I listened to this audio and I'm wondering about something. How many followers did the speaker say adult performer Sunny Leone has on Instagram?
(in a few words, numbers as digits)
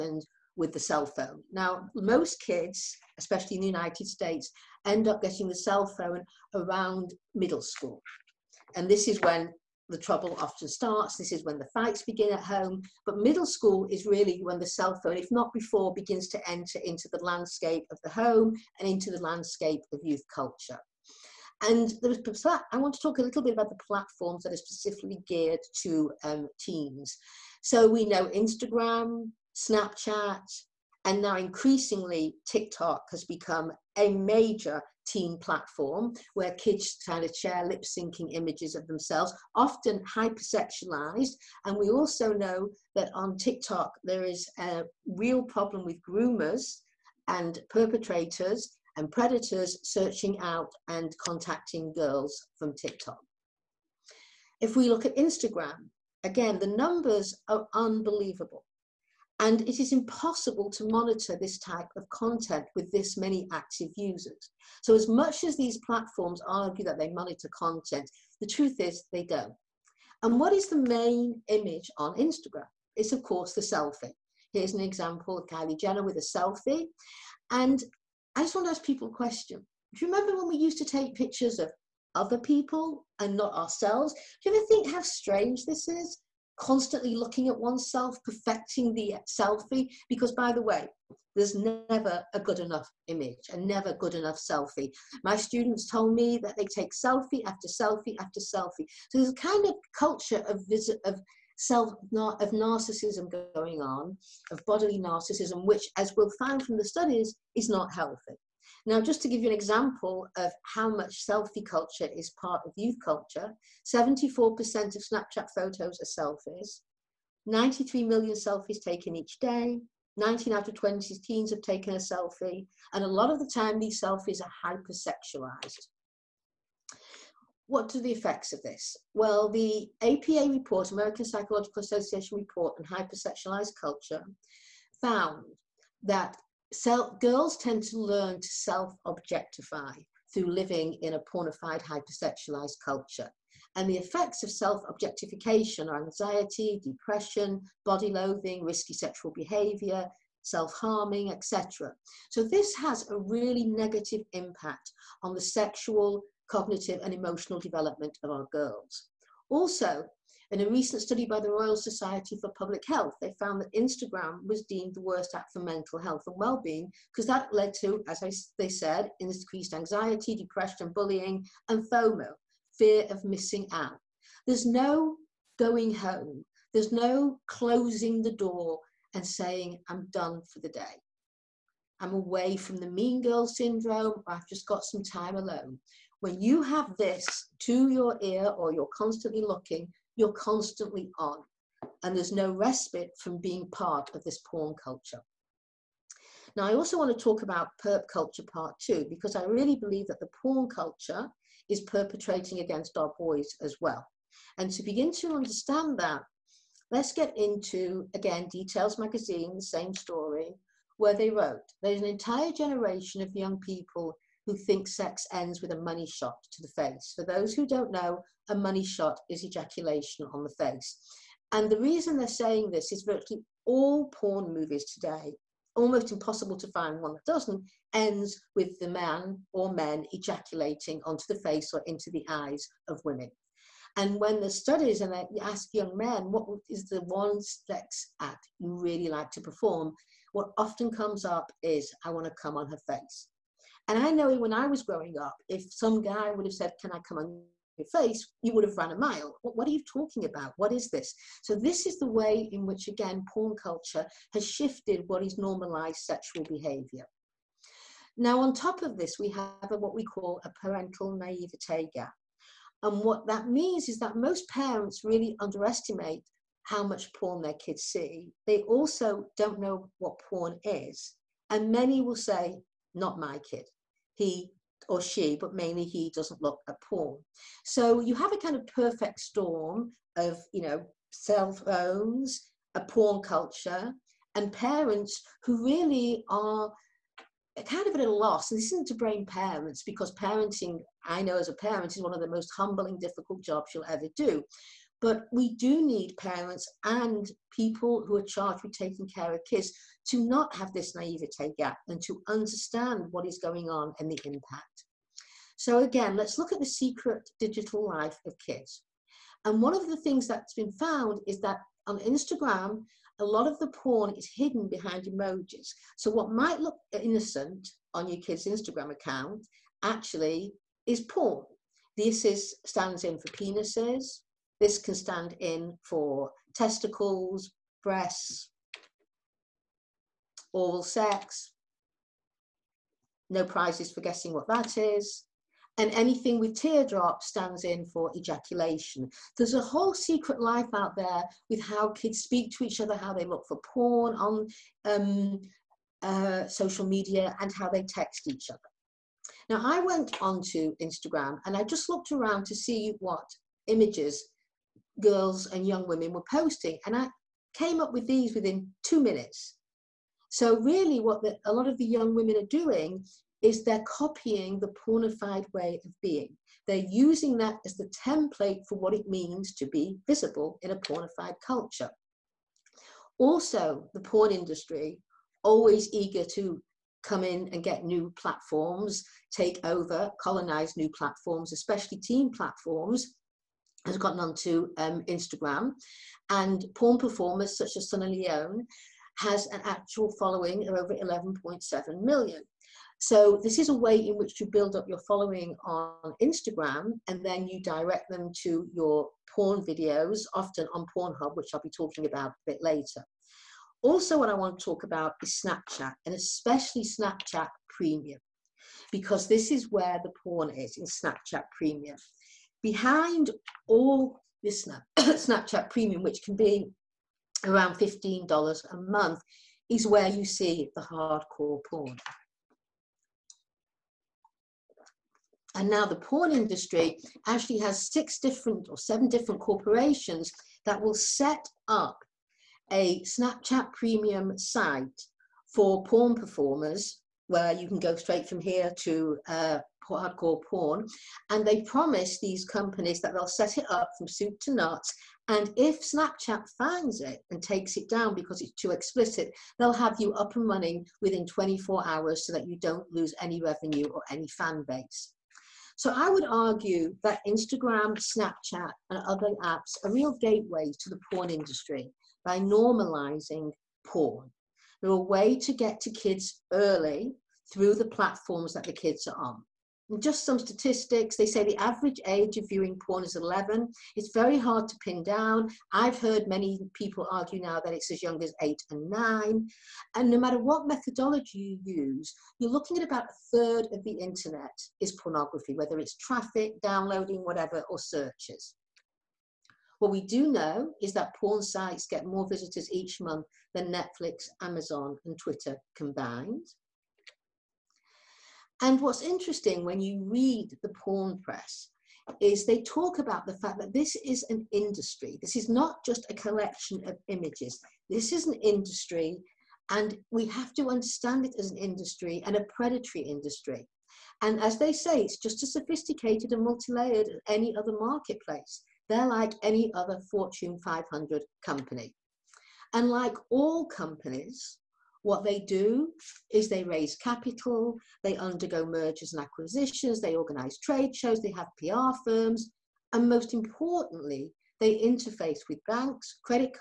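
11.7 million.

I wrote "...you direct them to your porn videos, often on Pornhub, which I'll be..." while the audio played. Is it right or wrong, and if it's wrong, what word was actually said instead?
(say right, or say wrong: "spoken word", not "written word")
right.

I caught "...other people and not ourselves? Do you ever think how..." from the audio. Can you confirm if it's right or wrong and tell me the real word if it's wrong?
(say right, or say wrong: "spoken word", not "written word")
right.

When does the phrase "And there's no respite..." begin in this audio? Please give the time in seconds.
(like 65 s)
192 s.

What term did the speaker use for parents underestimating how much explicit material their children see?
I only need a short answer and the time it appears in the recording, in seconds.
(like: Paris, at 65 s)
parental naivete gap, at 260 s.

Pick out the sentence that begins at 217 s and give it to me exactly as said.
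For those who don't know, a money shot is ejaculation on the face.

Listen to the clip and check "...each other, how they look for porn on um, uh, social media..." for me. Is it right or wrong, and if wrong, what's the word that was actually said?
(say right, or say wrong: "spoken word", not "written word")
right.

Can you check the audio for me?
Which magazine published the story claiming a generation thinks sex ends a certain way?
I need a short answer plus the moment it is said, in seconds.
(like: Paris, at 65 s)
Details Magazine, at 208 s.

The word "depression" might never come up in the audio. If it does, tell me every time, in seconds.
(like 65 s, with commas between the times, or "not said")
146 s, 170 s.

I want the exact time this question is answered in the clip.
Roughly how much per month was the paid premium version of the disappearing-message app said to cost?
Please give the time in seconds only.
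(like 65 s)
417 s.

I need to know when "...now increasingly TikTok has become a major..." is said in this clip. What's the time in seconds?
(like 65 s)
31 s.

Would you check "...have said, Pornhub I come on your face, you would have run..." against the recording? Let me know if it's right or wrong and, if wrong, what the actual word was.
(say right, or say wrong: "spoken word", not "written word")
wrong: "Can", not "Pornhub".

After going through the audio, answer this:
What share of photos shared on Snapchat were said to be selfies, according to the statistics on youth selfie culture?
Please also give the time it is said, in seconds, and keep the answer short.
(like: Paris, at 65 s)
74%, at 113 s.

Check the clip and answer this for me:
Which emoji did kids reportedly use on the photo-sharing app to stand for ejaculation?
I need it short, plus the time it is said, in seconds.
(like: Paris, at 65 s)
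teardrop, at 336 s.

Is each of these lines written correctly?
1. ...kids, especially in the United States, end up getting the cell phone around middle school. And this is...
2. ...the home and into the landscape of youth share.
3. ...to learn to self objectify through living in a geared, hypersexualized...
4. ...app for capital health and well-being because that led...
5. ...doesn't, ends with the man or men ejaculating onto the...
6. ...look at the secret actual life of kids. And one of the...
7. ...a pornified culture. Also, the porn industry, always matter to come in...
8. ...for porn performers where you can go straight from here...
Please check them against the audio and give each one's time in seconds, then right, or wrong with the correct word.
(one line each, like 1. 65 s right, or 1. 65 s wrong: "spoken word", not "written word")
1. 2 s right
2. 18 s wrong: "culture", not "share"
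3. 137 s wrong: "pornified", not "geared"
4. 165 s wrong: "mental", not "capital"
5. 227 s right
6. 306 s wrong: "digital", not "actual"
7. 370 s wrong: "eager", not "matter"
8. 435 s right.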